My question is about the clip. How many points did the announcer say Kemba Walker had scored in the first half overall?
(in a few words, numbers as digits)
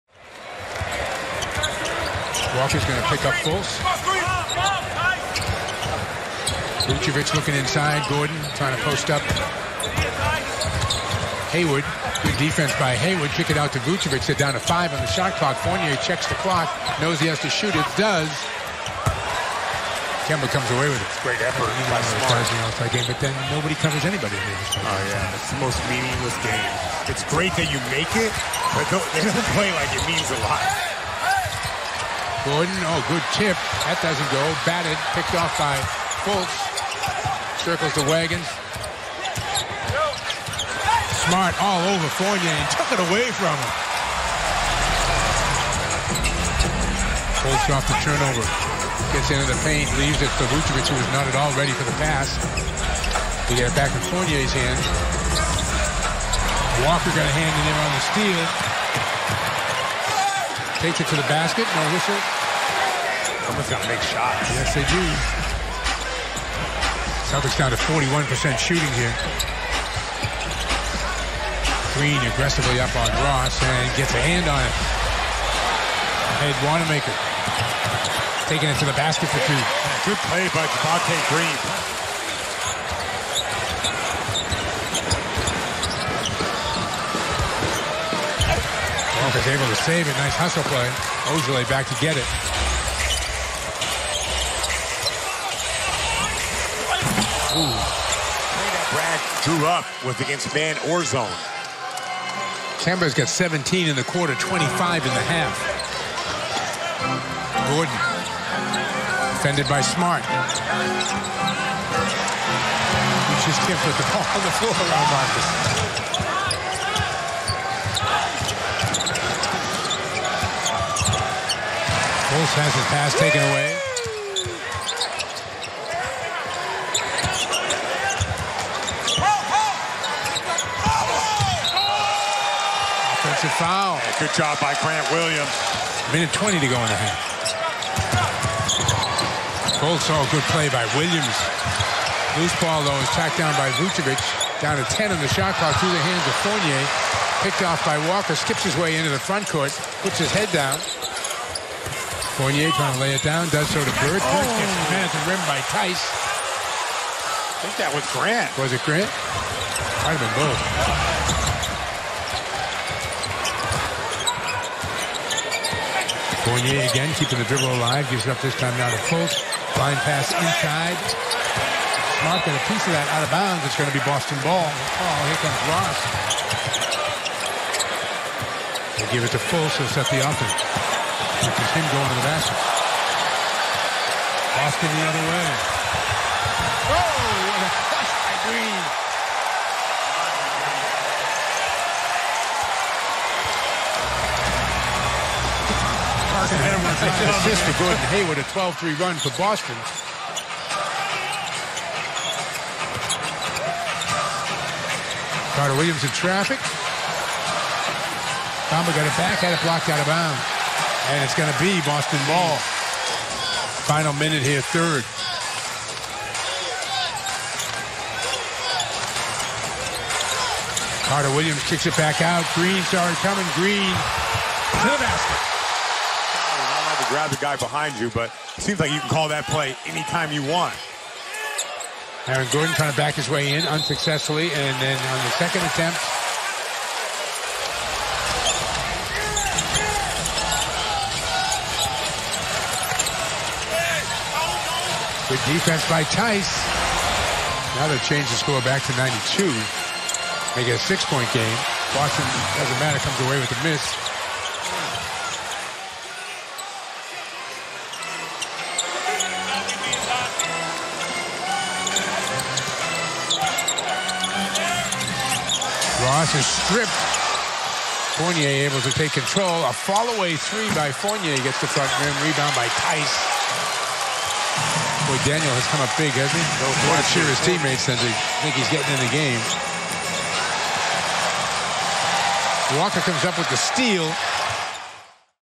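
25.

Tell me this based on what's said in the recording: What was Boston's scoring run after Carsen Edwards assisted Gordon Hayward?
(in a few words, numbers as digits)
12-3.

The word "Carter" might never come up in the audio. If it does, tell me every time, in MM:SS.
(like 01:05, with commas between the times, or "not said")
03:25, 03:41.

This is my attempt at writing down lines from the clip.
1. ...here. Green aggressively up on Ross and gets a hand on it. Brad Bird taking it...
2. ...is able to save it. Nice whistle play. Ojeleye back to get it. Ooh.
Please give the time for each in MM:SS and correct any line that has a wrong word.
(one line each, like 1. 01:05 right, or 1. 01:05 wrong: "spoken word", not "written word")
1. 01:08 wrong: "Wanamaker", not "Bird"
2. 01:29 wrong: "hustle", not "whistle".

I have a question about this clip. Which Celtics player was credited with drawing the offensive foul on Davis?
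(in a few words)
Grant Williams.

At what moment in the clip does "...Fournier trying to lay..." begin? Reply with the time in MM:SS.
02:32.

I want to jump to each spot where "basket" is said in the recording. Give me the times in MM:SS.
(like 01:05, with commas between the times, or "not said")
01:01, 01:18, 03:02, 03:45.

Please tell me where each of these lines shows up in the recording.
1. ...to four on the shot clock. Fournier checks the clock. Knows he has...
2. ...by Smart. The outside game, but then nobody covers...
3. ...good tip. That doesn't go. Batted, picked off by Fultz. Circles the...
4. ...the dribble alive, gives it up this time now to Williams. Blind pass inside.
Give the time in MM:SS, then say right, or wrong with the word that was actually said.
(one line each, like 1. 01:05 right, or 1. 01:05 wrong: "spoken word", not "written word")
1. 00:14 wrong: "five", not "four"
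2. 00:21 right
3. 00:33 right
4. 02:47 wrong: "Fultz", not "Williams".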